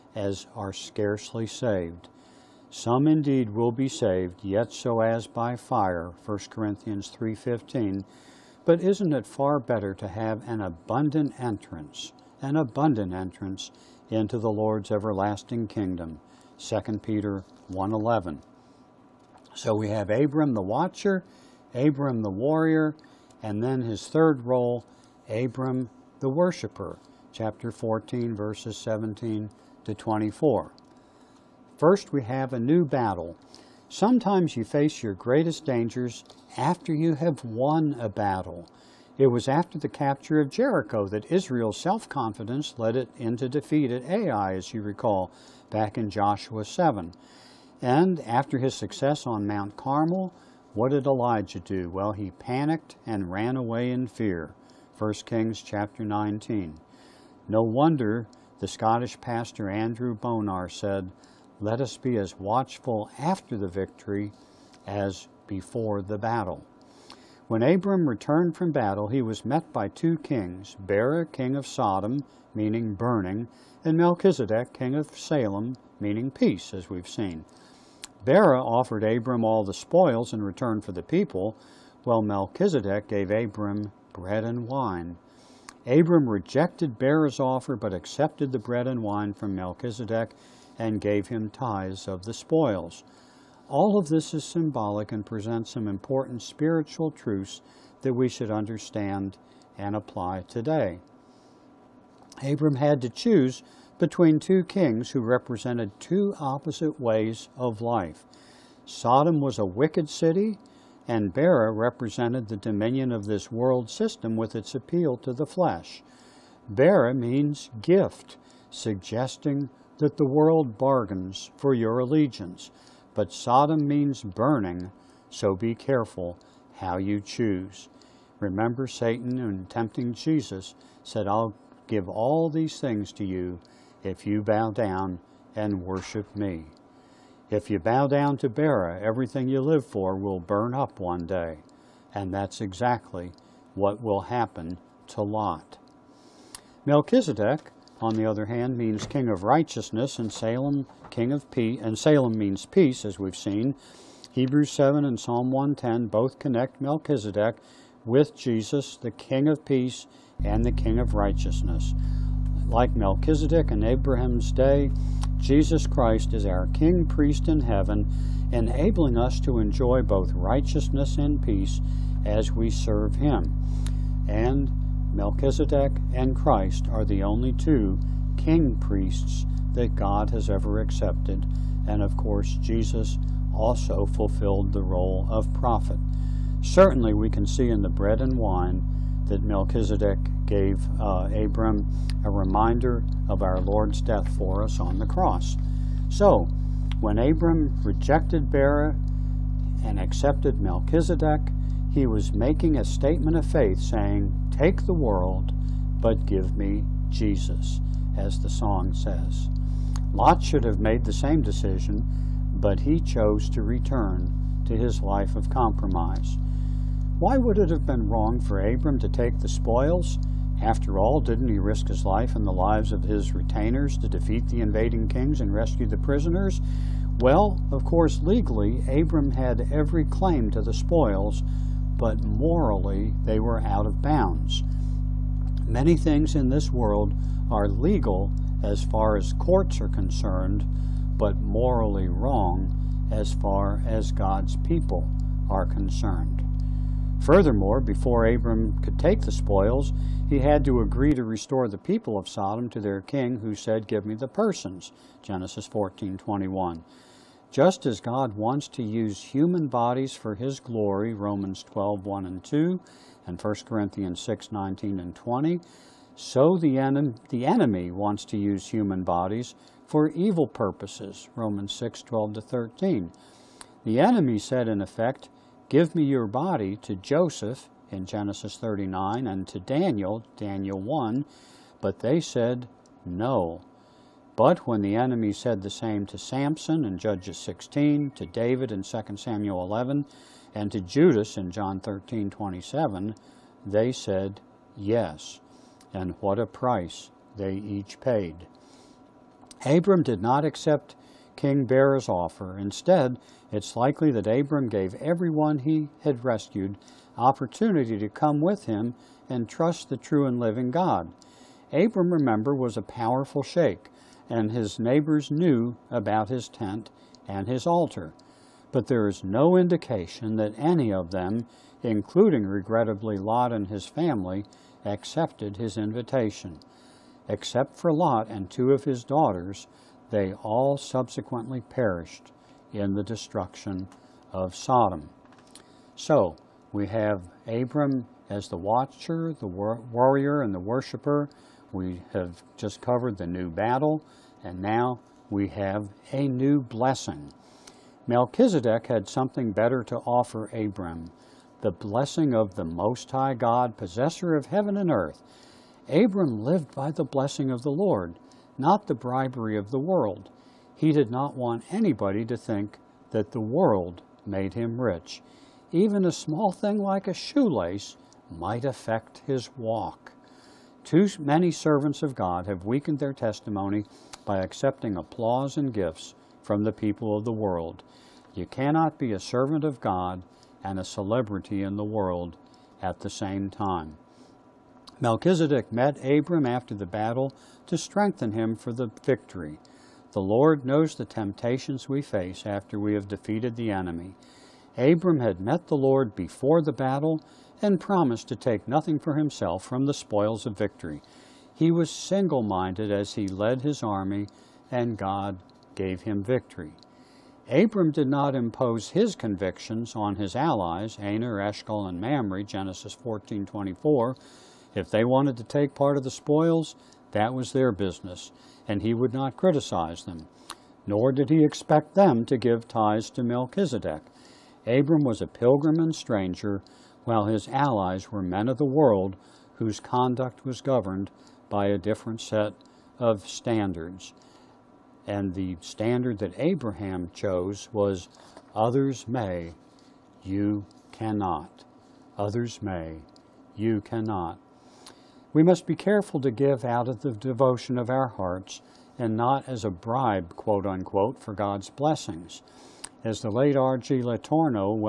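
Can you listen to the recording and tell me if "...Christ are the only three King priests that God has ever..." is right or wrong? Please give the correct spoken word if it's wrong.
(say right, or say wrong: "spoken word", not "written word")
wrong: "two", not "three".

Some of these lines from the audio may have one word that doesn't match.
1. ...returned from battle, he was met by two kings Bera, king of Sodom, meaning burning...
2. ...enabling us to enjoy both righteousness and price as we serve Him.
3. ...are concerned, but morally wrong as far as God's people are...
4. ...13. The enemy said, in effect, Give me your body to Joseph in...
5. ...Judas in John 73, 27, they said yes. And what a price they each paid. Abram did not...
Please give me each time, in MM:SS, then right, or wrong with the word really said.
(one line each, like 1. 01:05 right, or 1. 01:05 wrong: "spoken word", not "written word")
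1. 01:08 right
2. 02:48 wrong: "peace", not "price"
3. 03:59 right
4. 04:32 right
5. 04:50 wrong: "13", not "73".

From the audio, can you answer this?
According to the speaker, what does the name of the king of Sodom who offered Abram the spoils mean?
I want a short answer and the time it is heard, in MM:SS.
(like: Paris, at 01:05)
gift, at 01:57.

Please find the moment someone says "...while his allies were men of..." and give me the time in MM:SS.
07:07.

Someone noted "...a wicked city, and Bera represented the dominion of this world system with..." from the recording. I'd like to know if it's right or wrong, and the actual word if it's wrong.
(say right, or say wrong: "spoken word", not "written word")
right.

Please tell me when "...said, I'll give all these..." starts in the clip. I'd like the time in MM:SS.
02:11.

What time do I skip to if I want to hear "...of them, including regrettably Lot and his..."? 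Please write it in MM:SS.
05:20.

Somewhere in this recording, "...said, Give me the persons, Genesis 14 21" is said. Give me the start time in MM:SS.
04:13.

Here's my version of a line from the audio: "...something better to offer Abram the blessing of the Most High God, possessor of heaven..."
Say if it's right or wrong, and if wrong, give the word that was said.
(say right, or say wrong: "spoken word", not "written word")
right.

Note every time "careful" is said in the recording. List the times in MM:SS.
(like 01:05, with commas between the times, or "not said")
02:05, 07:25.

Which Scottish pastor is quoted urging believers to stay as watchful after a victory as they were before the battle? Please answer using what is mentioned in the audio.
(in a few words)
Andrew Bonar.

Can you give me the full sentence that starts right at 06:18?
You cannot be a servant of God and a celebrity in the world at the same time.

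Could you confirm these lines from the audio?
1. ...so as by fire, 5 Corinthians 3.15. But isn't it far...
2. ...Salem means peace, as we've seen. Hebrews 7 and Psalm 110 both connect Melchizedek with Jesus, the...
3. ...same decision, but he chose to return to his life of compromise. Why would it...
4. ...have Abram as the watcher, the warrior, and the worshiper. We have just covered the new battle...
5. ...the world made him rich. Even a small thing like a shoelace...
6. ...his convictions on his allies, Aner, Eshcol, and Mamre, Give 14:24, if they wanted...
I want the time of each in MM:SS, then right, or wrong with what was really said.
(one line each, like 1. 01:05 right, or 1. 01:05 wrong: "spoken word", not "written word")
1. 00:04 wrong: "1", not "5"
2. 02:31 right
3. 03:31 right
4. 05:36 right
5. 06:03 right
6. 06:48 wrong: "Genesis", not "Give".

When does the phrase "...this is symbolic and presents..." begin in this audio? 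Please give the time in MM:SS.
01:34.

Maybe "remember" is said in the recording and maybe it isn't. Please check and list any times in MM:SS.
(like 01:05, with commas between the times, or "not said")
02:08, 05:12.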